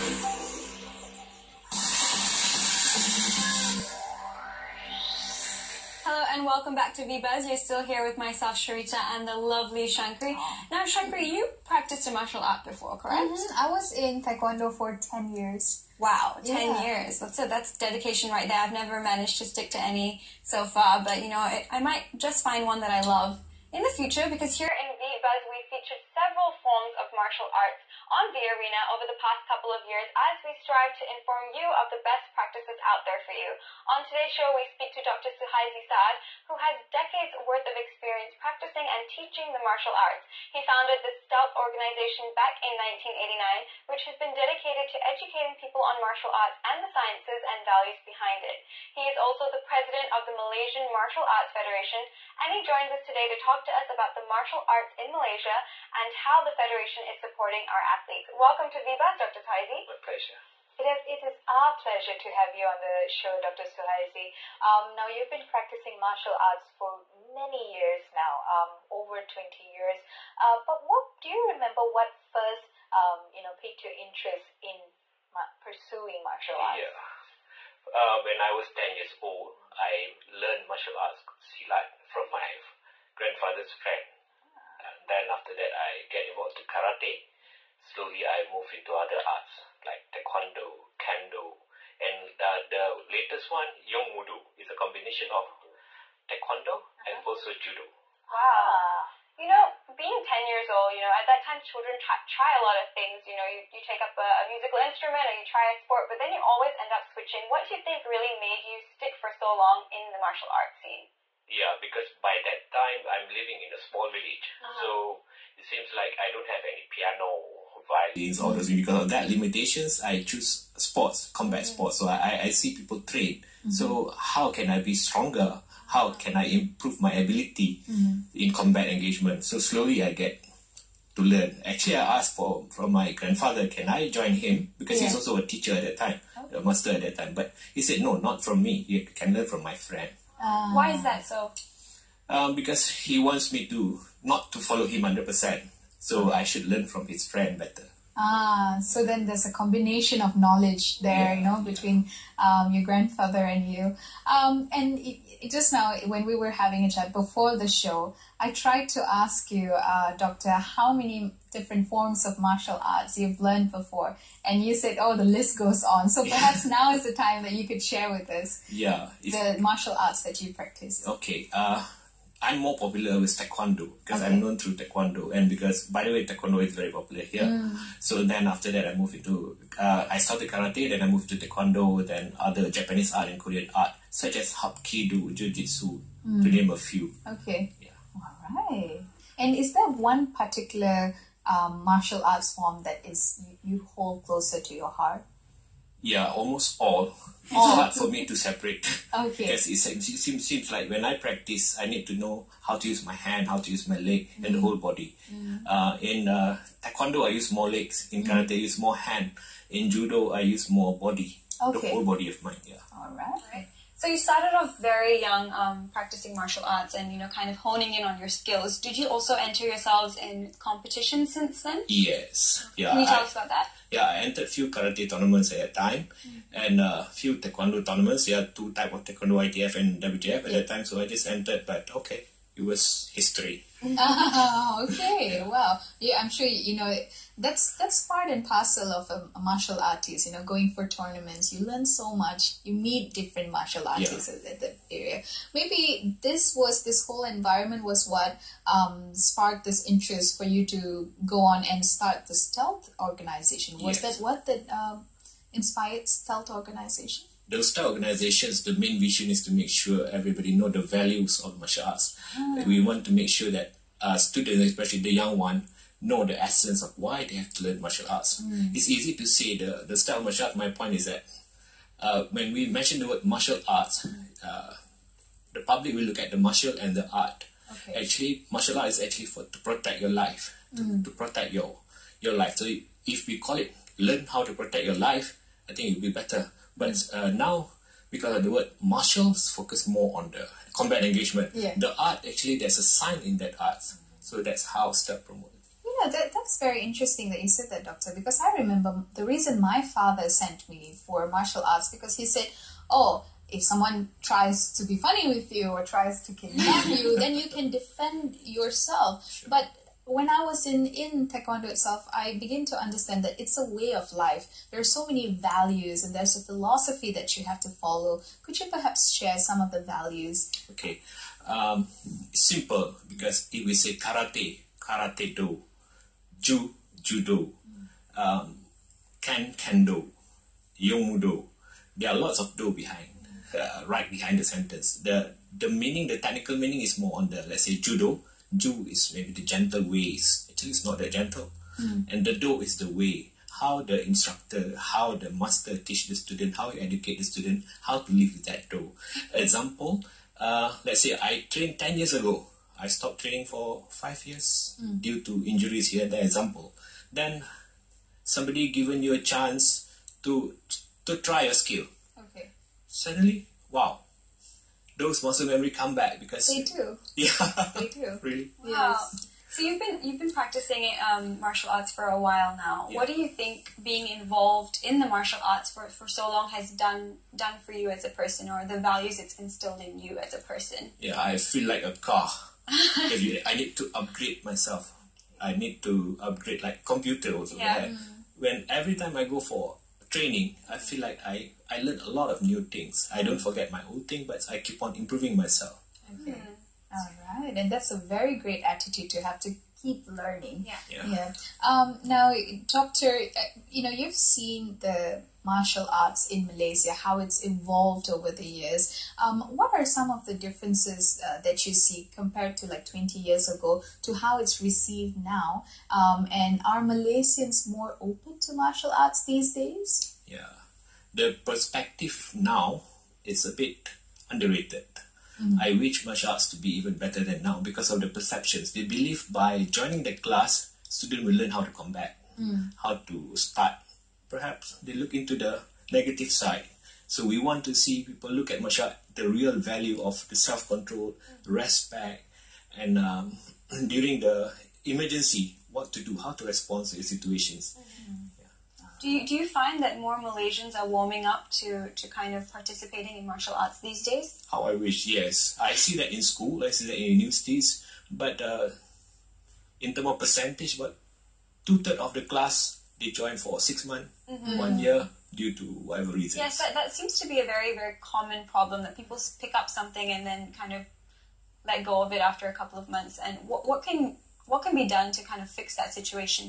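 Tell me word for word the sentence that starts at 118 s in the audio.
Because of that limitations, I choose sports, combat sports.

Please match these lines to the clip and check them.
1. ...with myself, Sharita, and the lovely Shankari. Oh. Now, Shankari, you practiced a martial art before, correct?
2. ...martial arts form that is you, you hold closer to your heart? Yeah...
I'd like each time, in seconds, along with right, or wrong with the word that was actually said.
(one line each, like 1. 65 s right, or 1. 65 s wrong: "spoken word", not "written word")
1. 8 s right
2. 191 s right.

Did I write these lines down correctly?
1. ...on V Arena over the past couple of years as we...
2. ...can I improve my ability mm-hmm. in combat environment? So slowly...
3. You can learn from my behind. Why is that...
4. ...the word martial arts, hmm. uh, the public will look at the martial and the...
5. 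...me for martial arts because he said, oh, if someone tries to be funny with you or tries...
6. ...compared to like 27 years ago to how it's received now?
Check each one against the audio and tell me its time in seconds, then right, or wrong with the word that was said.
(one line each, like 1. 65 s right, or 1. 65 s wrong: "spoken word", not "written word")
1. 28 s right
2. 126 s wrong: "engagement", not "environment"
3. 138 s wrong: "friend", not "behind"
4. 272 s right
5. 300 s right
6. 412 s wrong: "20", not "27".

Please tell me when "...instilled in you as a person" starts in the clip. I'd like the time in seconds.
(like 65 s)
379 s.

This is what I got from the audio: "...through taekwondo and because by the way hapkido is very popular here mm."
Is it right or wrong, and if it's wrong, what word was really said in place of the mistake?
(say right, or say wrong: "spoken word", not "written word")
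wrong: "taekwondo", not "hapkido".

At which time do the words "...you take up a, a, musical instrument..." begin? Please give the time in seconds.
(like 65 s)
103 s.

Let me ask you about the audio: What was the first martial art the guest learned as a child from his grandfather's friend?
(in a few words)
Silat.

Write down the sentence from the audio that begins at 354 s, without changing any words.
due to injuries here the example.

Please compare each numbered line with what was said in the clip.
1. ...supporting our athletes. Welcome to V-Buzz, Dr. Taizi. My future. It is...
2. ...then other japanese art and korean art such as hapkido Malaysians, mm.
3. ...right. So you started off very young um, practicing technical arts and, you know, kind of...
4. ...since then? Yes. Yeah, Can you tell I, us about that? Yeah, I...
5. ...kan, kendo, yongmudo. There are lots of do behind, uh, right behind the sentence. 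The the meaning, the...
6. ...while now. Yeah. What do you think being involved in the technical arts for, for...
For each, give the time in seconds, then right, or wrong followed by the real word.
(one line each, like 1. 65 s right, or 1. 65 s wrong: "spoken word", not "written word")
1. 57 s wrong: "pleasure", not "future"
2. 182 s wrong: "Jujitsu", not "Malaysians"
3. 213 s wrong: "martial", not "technical"
4. 221 s right
5. 329 s right
6. 372 s wrong: "martial", not "technical".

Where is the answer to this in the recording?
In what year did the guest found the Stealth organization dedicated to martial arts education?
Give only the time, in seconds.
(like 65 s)
42 s.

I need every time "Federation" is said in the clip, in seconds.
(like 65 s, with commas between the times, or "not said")
51 s, 56 s.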